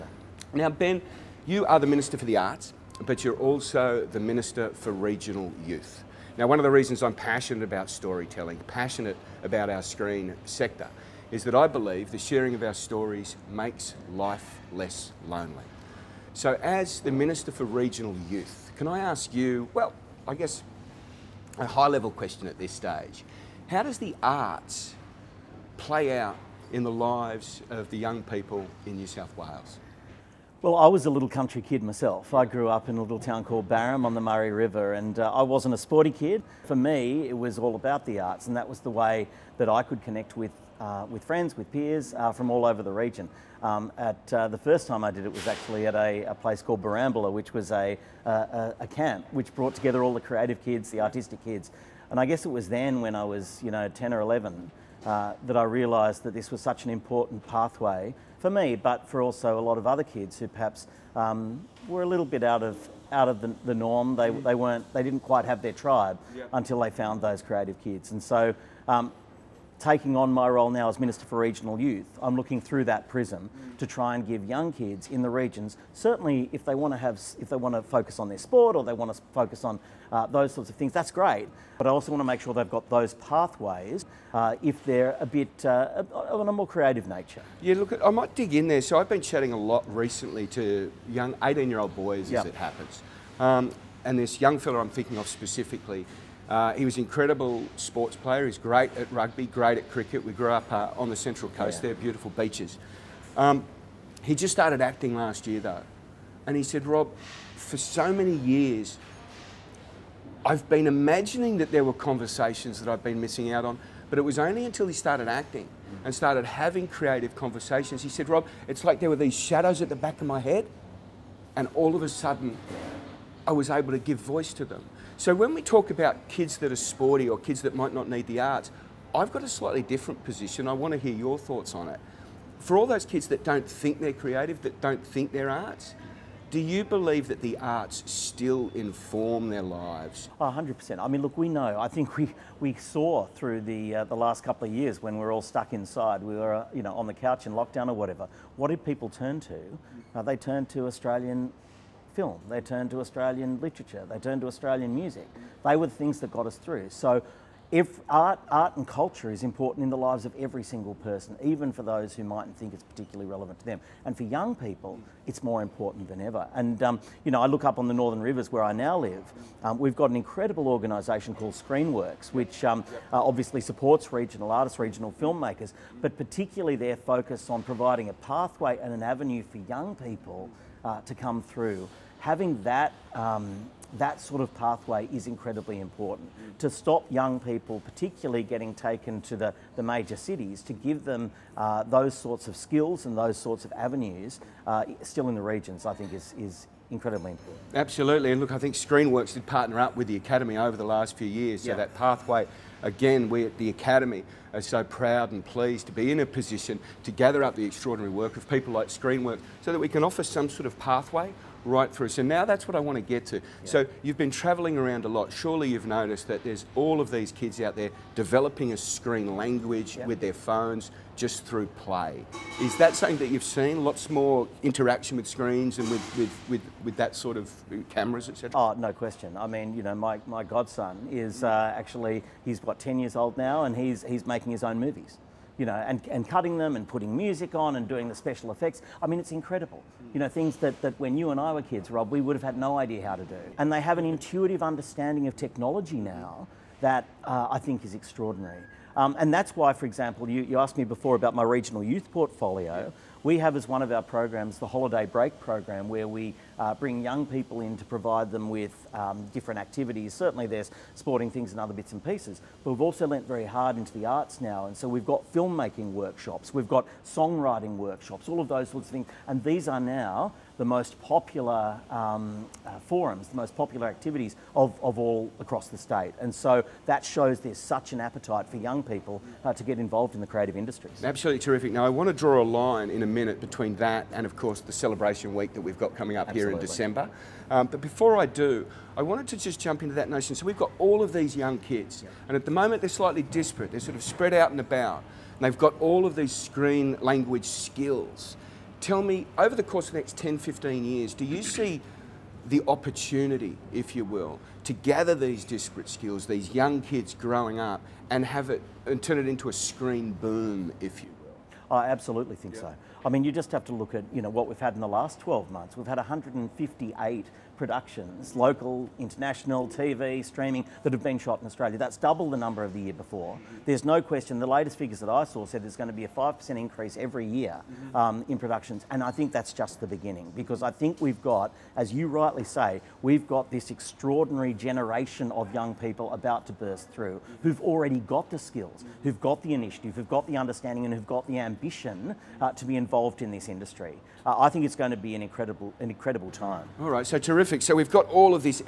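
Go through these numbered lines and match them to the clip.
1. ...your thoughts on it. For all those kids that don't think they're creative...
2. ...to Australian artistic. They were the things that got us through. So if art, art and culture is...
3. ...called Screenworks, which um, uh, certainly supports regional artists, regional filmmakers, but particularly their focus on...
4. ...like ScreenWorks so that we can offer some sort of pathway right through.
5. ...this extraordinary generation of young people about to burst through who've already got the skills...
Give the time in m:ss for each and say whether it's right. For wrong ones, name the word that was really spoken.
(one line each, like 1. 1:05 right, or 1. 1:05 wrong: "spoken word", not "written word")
1. 2:11 right
2. 2:34 wrong: "music", not "artistic"
3. 2:51 wrong: "obviously", not "certainly"
4. 3:28 right
5. 5:33 right.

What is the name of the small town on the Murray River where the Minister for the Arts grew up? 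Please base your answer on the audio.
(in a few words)
Barham.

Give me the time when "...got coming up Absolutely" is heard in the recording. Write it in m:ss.
4:45.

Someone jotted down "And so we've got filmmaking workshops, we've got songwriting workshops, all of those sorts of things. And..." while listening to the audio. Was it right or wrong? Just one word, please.
right.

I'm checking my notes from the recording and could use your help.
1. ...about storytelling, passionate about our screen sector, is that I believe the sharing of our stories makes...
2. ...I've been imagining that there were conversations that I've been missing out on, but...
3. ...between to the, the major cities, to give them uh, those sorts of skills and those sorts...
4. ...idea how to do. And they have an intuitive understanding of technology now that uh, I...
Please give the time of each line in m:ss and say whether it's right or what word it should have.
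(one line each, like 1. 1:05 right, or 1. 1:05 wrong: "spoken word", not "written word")
1. 0:07 right
2. 1:50 right
3. 3:08 wrong: "taken", not "between"
4. 4:02 right.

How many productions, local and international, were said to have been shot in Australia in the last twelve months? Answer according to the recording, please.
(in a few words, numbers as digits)
158.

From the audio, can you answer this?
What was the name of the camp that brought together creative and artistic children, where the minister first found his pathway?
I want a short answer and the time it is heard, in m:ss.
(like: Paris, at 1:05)
Borambola, at 0:46.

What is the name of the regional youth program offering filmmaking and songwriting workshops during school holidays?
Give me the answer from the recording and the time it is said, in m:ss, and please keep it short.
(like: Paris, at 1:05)
Holiday Break program, at 4:14.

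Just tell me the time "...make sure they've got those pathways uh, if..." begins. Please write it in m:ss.
1:22.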